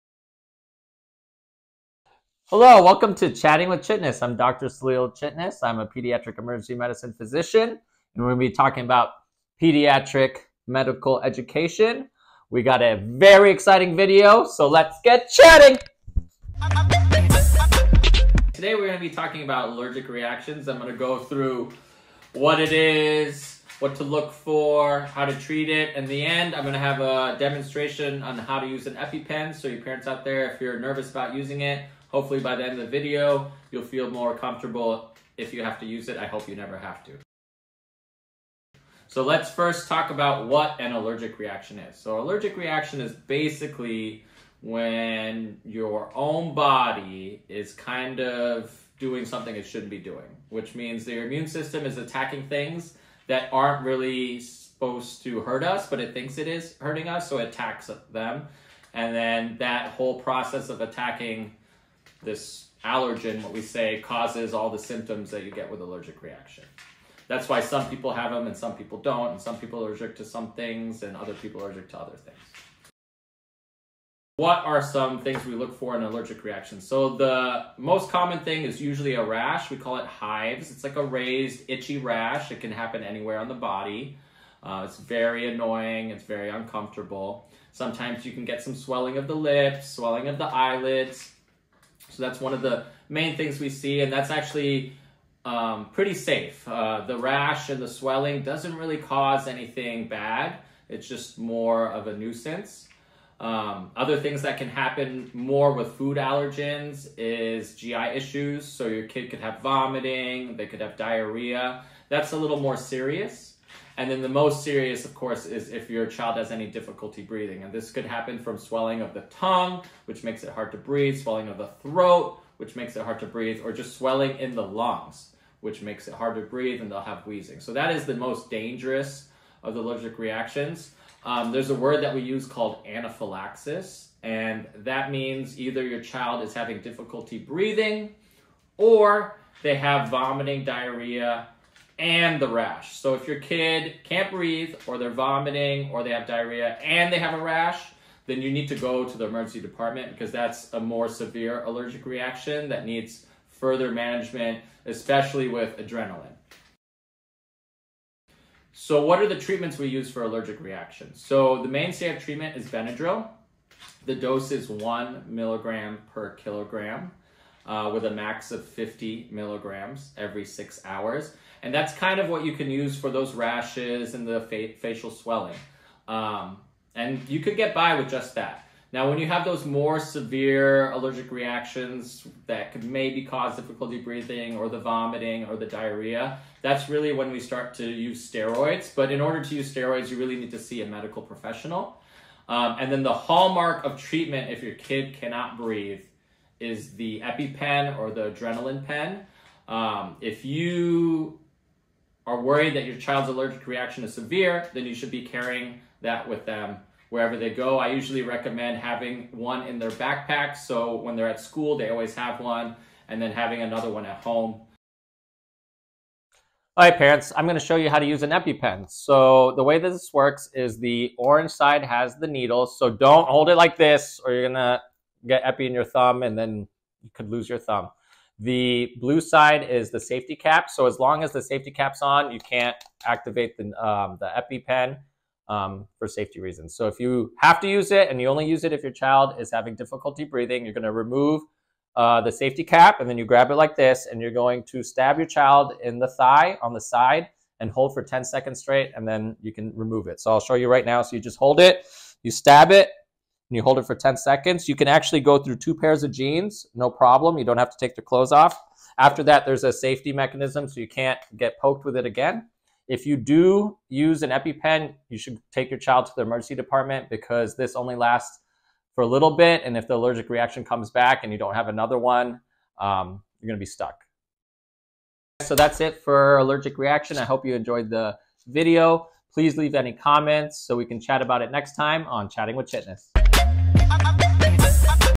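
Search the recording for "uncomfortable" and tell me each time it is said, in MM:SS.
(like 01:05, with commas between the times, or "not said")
01:26.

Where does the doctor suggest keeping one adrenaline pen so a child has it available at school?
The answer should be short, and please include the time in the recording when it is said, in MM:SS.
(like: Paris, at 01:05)
In their backpack, at 03:29.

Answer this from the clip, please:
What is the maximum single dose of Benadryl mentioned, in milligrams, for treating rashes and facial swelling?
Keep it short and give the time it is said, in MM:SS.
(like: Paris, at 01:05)
50 milligrams, at 02:48.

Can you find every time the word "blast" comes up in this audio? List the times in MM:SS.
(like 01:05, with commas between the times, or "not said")
not said.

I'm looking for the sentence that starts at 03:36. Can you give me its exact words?
All right, parents, I'm going to show you how to use an EpiPen.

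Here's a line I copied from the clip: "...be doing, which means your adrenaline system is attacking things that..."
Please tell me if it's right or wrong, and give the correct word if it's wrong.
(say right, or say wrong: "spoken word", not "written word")
wrong: "immune", not "adrenaline".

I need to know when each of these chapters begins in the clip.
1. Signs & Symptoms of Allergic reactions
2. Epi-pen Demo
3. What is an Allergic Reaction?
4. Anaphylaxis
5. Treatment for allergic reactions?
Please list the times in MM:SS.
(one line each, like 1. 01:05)
1. 01:13
2. 03:35
3. 00:37
4. 02:13
5. 02:37.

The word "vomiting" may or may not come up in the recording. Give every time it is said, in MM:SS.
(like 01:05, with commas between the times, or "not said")
01:49, 02:20, 02:25, 03:04.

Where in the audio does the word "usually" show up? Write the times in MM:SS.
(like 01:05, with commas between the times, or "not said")
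01:18, 03:27.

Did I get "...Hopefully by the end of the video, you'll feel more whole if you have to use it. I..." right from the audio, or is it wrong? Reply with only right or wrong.
wrong.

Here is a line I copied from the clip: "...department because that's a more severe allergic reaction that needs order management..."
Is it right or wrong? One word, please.
wrong.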